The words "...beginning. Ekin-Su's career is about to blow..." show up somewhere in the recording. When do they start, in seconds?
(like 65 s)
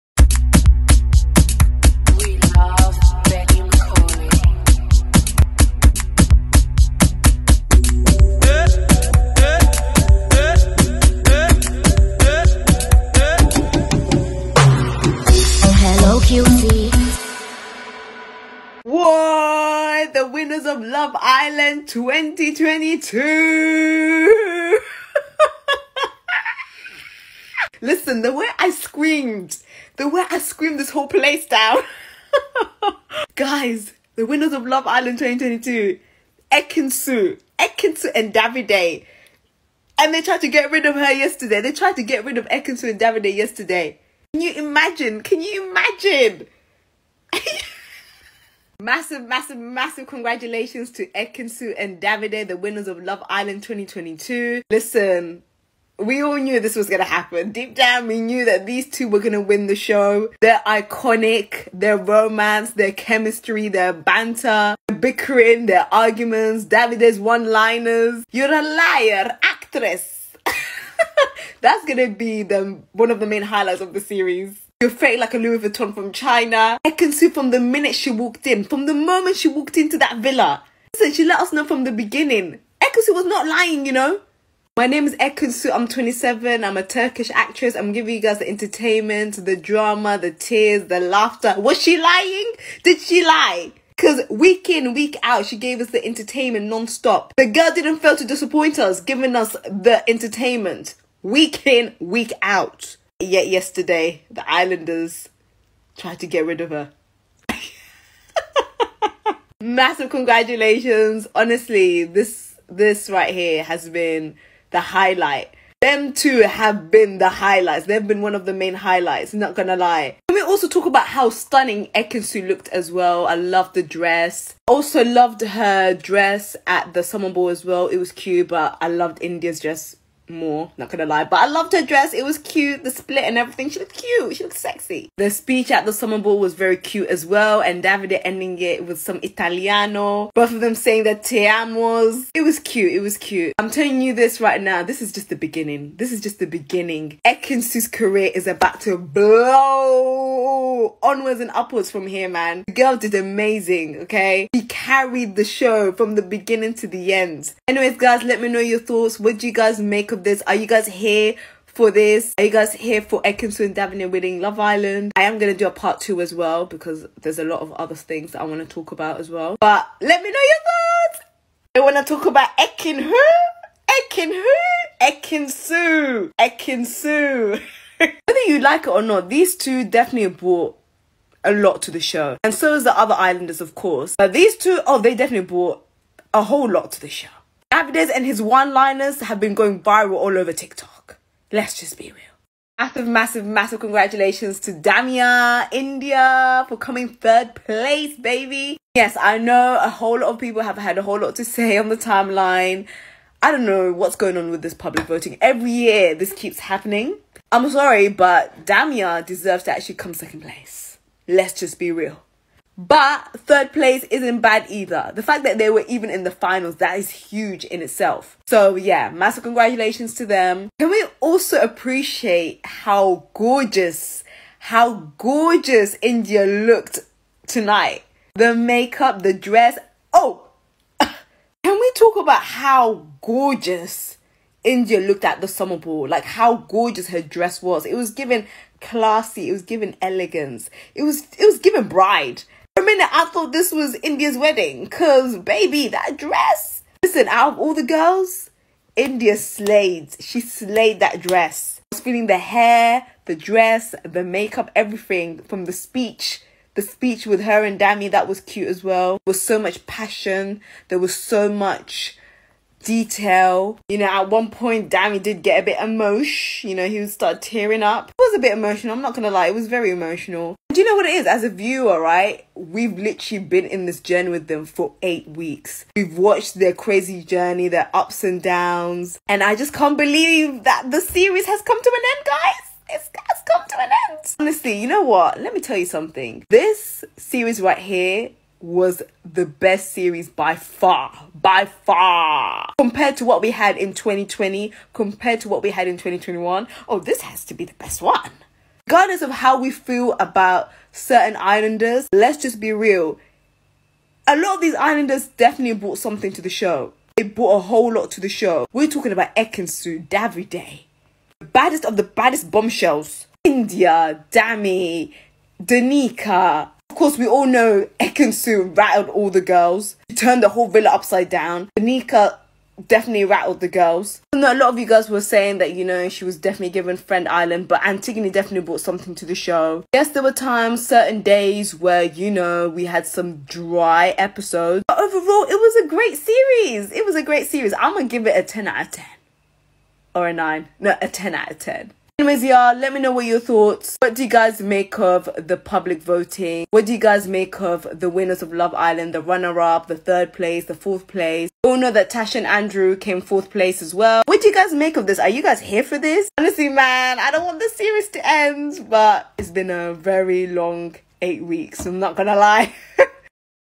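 146 s.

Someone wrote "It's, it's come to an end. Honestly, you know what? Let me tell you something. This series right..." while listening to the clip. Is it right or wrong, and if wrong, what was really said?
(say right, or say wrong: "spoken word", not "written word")
right.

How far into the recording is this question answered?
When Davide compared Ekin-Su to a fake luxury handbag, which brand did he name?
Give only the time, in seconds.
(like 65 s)
75 s.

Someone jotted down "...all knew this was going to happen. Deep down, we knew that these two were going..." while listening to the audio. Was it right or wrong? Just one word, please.
right.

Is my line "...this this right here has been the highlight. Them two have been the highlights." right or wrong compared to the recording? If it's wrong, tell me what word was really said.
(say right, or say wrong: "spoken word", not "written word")
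right.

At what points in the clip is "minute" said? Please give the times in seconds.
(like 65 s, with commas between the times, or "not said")
77 s, 242 s.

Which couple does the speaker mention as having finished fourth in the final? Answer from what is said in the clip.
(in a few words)
Tash and Andrew.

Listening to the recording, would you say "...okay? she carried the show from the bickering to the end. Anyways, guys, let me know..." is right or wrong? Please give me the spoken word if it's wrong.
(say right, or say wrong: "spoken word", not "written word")
wrong: "beginning", not "bickering".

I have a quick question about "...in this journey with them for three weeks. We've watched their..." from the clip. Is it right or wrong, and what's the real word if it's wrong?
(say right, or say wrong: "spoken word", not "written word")
wrong: "eight", not "three".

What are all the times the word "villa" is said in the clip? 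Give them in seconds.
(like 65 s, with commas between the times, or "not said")
80 s, 320 s.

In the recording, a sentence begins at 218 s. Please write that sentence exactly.
So yeah, massive congratulations to them.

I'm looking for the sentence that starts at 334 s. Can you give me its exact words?
But overall, it was a great series.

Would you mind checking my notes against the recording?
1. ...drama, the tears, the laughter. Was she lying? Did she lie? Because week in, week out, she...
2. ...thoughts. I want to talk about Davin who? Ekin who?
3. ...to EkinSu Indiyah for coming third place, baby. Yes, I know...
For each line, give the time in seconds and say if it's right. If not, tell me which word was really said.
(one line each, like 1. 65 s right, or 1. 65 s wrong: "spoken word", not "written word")
1. 89 s right
2. 170 s wrong: "Ekin", not "Davin"
3. 194 s wrong: "Damia", not "EkinSu".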